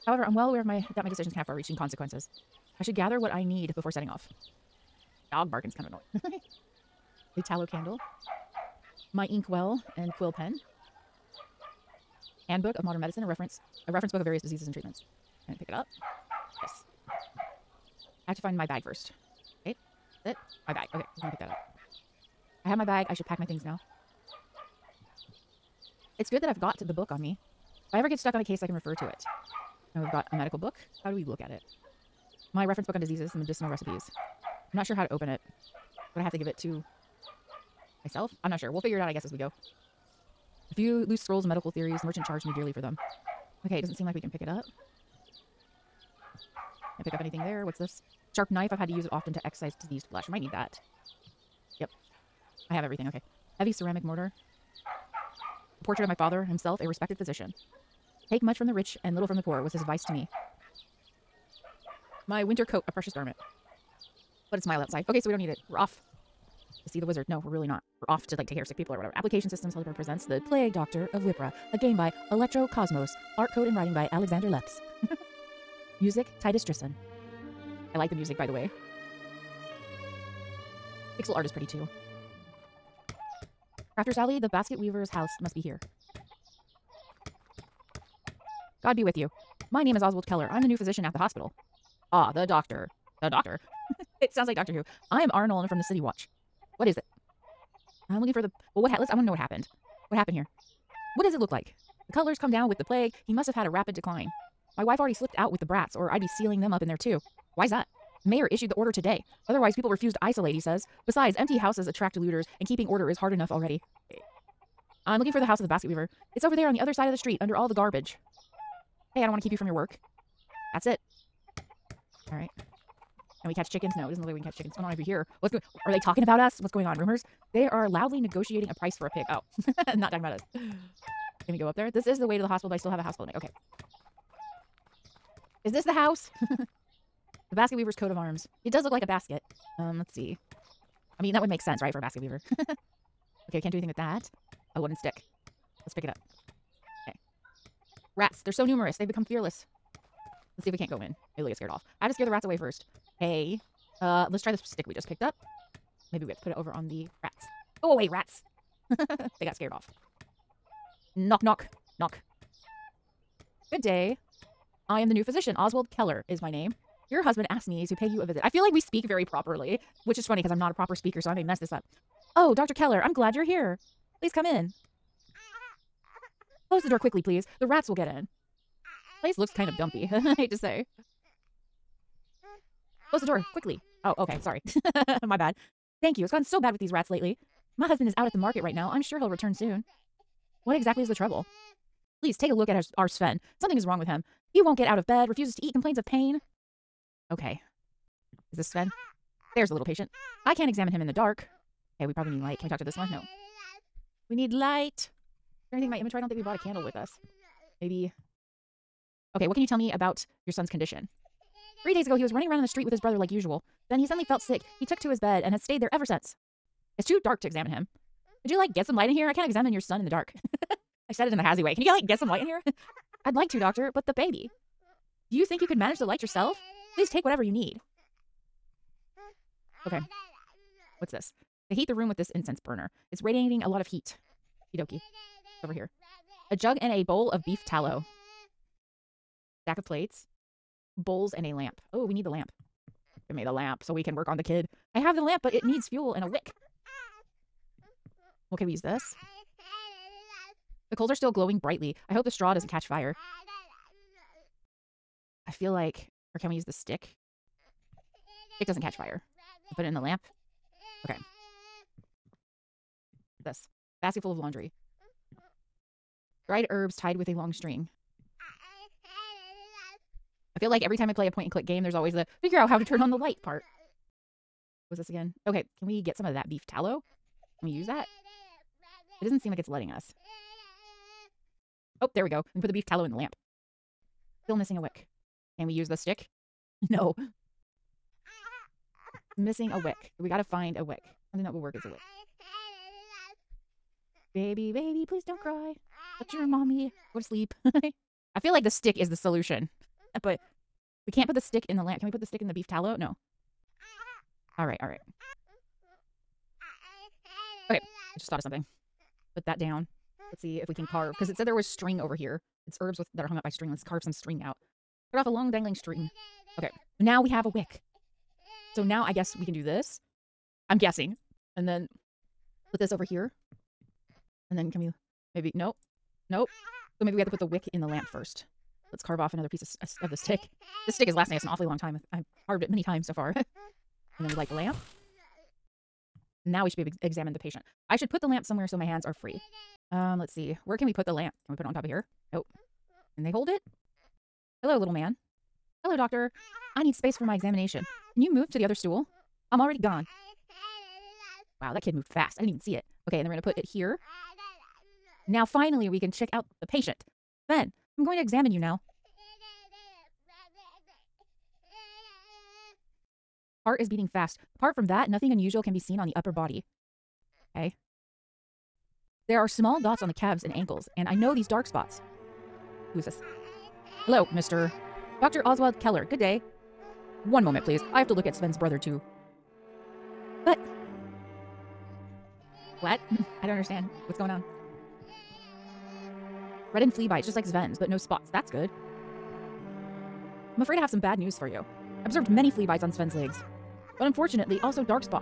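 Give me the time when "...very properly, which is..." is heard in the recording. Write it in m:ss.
2:49.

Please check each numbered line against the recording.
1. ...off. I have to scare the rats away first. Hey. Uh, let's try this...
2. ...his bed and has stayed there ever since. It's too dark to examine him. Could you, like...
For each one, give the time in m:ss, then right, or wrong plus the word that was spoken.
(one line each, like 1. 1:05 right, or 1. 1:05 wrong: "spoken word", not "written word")
1. 2:31 right
2. 3:35 right.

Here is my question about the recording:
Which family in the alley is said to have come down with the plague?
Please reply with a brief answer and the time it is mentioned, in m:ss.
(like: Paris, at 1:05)
The Cutlers, at 1:42.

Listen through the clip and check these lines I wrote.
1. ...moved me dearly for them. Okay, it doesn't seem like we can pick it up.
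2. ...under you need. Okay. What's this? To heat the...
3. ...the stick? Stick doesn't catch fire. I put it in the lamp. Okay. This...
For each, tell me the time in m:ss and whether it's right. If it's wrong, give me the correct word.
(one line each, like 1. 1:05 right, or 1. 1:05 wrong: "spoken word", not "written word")
1. 0:42 wrong: "charged", not "moved"
2. 3:47 wrong: "whatever", not "under"
3. 4:16 right.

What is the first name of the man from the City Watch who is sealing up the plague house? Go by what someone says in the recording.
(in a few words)
Arnold.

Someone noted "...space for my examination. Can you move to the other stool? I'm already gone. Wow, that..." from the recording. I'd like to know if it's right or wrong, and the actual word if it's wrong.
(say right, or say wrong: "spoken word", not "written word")
right.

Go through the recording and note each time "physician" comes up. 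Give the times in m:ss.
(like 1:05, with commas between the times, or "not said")
0:57, 1:30, 2:45.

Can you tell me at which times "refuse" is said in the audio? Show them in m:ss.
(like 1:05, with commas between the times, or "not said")
1:49, 3:15.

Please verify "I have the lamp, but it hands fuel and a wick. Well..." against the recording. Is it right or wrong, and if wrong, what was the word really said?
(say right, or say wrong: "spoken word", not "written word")
wrong: "needs", not "hands".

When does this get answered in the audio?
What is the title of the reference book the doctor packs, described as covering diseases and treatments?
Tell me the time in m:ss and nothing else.
0:12.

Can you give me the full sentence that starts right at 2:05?
What's going Are they talking about us?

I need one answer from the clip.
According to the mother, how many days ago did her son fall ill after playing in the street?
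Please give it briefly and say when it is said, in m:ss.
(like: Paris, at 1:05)
3, at 3:31.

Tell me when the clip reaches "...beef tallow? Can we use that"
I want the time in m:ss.
4:36.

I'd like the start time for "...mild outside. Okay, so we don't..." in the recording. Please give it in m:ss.
1:04.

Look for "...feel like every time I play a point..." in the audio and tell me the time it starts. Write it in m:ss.
4:30.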